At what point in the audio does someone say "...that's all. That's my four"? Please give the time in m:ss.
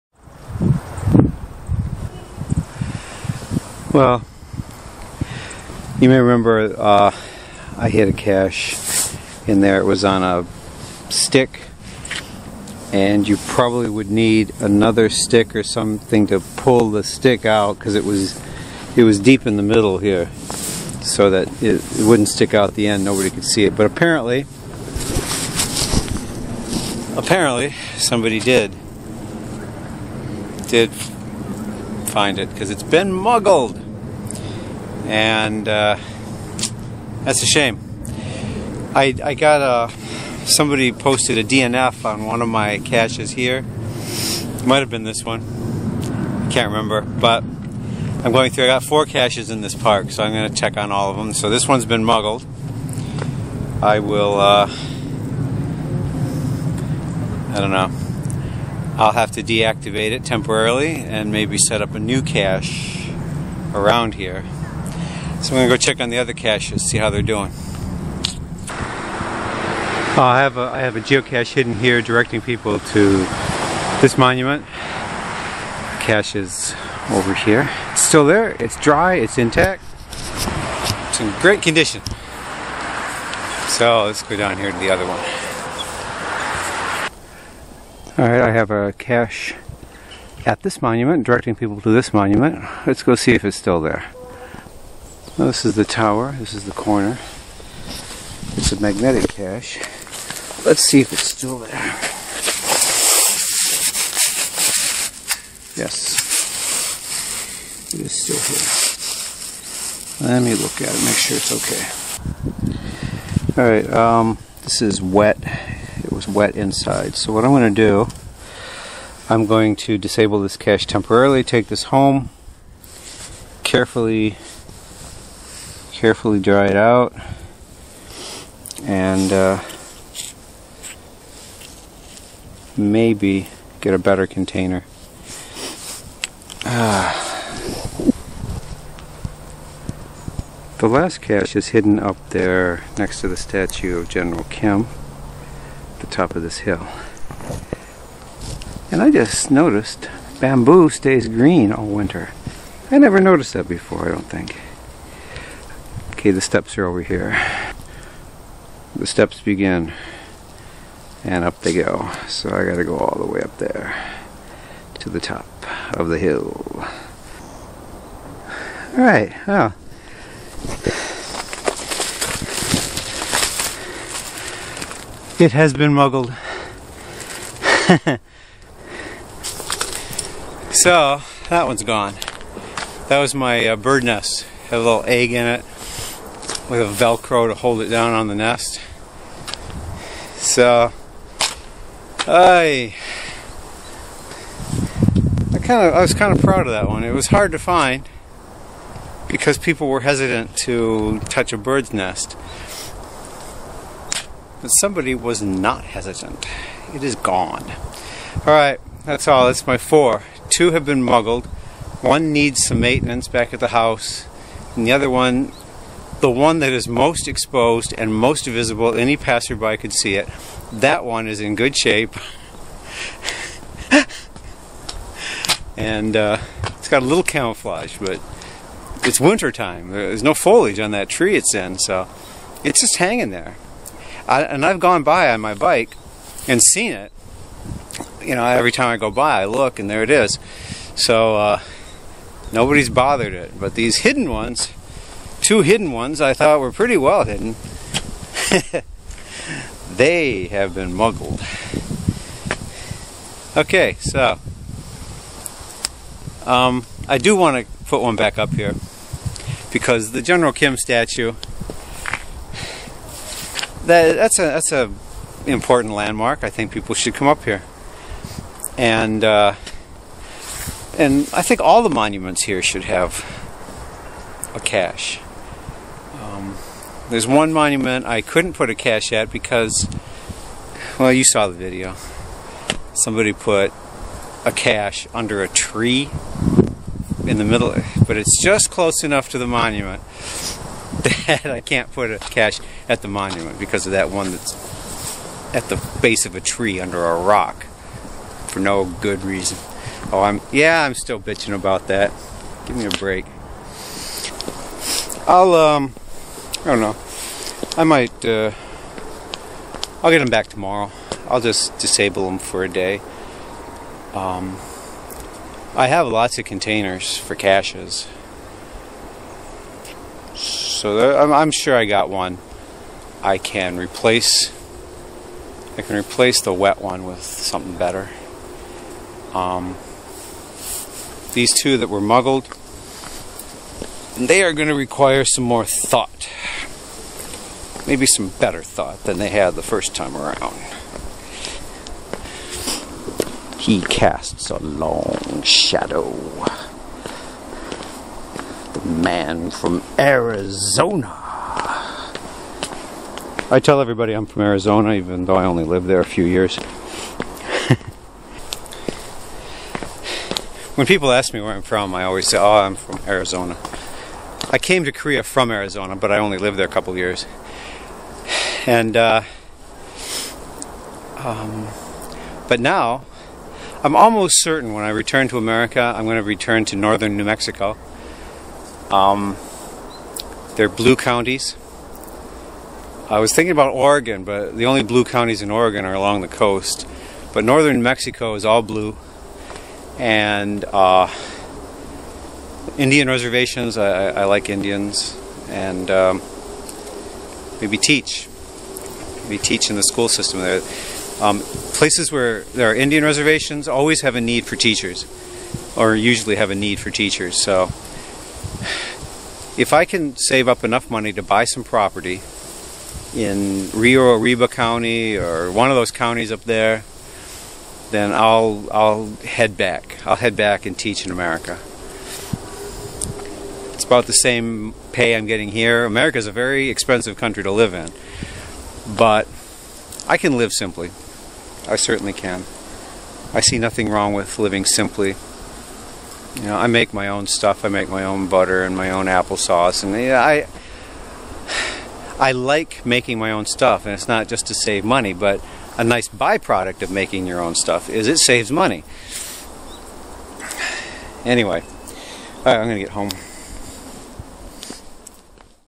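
3:29.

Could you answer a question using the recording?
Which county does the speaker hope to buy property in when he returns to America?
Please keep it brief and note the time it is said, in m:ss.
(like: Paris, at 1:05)
Rio Arriba County, at 6:53.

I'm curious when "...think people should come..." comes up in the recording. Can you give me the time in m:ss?
4:26.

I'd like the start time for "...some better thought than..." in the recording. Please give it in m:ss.
5:38.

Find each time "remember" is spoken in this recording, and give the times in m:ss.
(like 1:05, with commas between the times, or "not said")
0:06, 0:46.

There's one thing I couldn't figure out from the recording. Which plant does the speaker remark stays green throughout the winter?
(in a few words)
bamboo.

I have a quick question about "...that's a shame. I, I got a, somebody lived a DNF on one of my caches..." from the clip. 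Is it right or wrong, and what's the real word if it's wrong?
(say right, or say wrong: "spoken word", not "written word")
wrong: "posted", not "lived".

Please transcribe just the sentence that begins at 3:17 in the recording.
It was hard to find because people were hesitant to touch a bird's nest.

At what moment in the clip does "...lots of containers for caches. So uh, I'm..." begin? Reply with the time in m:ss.
5:16.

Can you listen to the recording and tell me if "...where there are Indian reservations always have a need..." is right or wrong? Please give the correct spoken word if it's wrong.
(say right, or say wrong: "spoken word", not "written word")
right.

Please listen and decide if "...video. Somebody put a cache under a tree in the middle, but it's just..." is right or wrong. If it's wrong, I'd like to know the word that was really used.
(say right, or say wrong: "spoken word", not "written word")
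right.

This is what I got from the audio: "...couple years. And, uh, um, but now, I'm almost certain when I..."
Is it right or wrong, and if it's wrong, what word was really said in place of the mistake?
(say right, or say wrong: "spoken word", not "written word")
right.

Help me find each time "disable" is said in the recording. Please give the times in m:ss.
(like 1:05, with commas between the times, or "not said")
1:59, 5:11.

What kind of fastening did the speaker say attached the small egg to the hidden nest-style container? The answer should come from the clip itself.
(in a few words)
velcro.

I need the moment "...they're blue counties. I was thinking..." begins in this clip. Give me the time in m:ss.
6:20.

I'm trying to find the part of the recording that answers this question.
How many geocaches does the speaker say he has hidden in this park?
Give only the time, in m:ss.
0:48.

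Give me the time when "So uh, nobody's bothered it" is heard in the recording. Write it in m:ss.
4:00.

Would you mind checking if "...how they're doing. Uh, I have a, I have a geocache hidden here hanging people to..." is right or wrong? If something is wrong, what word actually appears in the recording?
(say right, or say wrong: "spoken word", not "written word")
wrong: "directing", not "hanging".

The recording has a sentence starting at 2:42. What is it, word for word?
So I gotta go all the way up there to the top of the hill.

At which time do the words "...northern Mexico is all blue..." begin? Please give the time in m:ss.
6:27.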